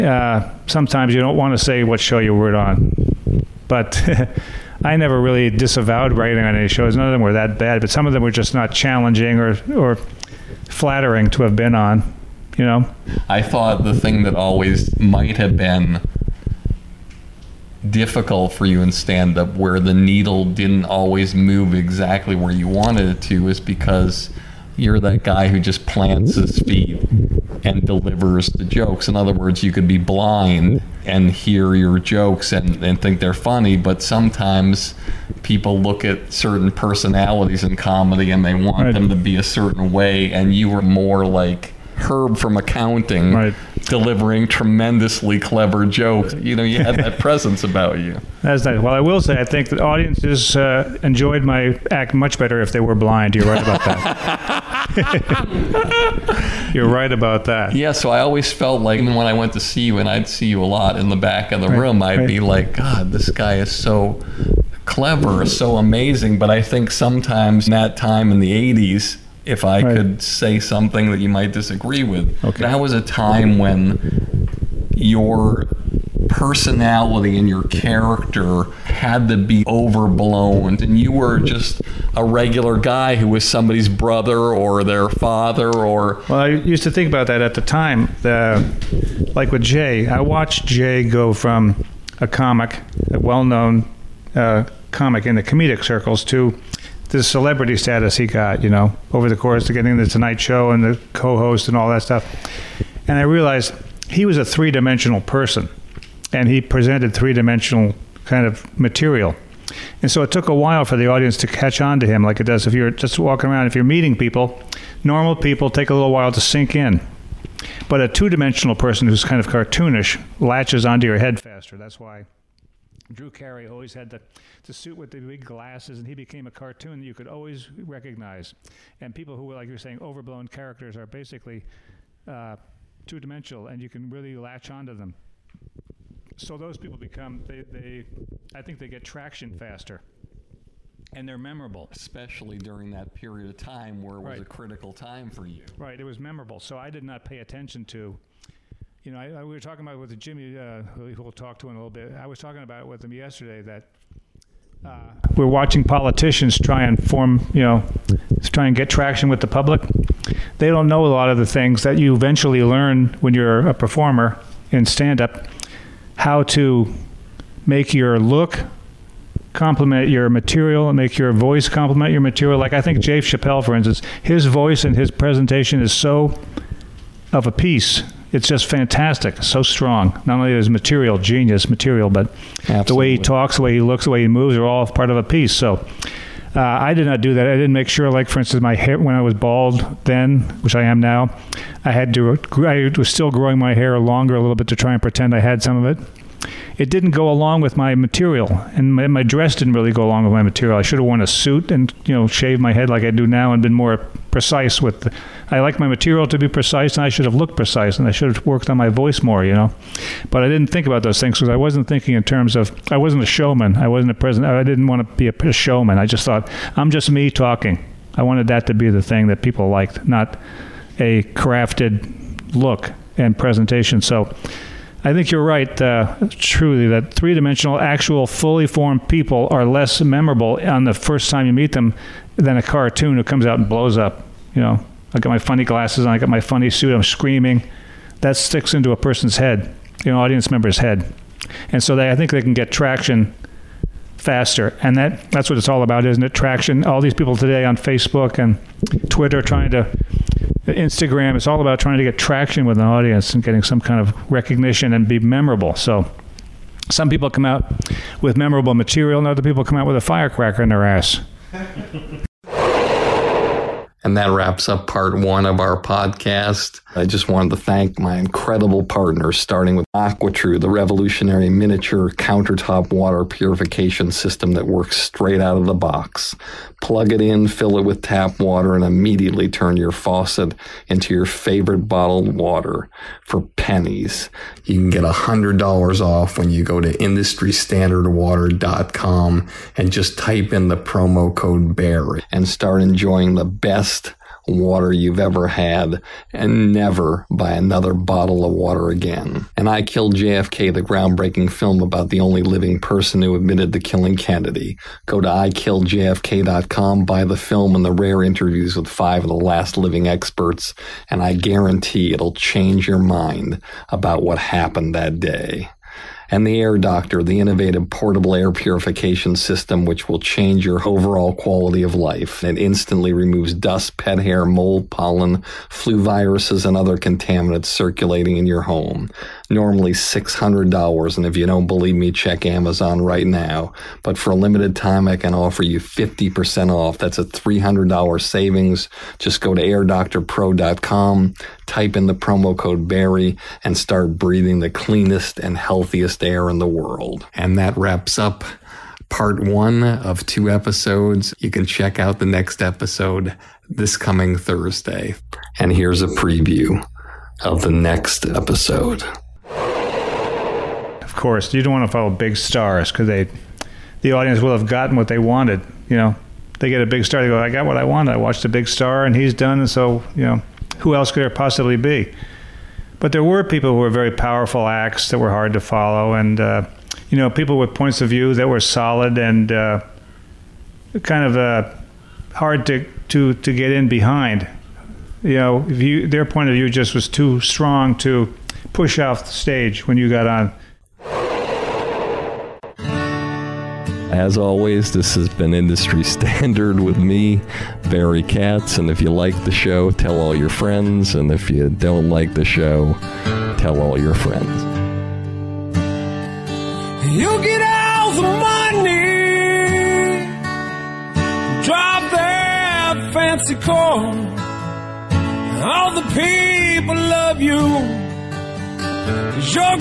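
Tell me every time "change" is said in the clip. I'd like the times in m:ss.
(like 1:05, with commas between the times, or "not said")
5:12, 5:20.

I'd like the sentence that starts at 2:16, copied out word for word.
So those people become, they, they, I think they get traction faster.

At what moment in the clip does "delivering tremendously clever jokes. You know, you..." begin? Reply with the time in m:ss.
0:43.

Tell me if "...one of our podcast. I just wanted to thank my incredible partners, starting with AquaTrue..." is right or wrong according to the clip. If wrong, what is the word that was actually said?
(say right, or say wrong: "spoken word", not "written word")
right.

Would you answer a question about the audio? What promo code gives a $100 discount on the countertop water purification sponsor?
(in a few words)
BEAR.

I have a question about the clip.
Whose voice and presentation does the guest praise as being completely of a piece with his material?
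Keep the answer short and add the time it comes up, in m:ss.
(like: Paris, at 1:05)
Dave Chappelle, at 2:53.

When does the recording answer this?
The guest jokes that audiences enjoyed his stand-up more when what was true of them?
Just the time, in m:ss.
0:52.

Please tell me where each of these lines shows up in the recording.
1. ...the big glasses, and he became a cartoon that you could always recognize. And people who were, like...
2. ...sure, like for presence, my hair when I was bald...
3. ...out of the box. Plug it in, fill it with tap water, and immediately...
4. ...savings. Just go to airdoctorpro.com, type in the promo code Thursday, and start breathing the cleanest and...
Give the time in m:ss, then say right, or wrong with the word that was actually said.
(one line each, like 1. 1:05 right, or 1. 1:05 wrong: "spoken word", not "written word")
1. 2:05 right
2. 3:07 wrong: "instance", not "presence"
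3. 4:35 right
4. 5:38 wrong: "Barry", not "Thursday".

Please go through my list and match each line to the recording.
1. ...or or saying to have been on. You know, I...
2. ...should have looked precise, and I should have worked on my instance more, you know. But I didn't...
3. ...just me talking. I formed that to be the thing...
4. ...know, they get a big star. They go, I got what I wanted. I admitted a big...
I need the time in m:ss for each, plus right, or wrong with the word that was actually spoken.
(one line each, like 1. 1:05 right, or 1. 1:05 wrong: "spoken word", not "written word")
1. 0:09 wrong: "flattering", not "saying"
2. 3:27 wrong: "voice", not "instance"
3. 3:36 wrong: "wanted", not "formed"
4. 6:05 wrong: "watched", not "admitted".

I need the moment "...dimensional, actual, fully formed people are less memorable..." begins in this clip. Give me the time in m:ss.
3:47.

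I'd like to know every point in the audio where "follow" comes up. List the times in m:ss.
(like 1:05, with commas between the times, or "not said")
6:01, 6:15.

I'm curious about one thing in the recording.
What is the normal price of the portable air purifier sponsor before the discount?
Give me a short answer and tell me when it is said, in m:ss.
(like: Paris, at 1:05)
$600, at 5:29.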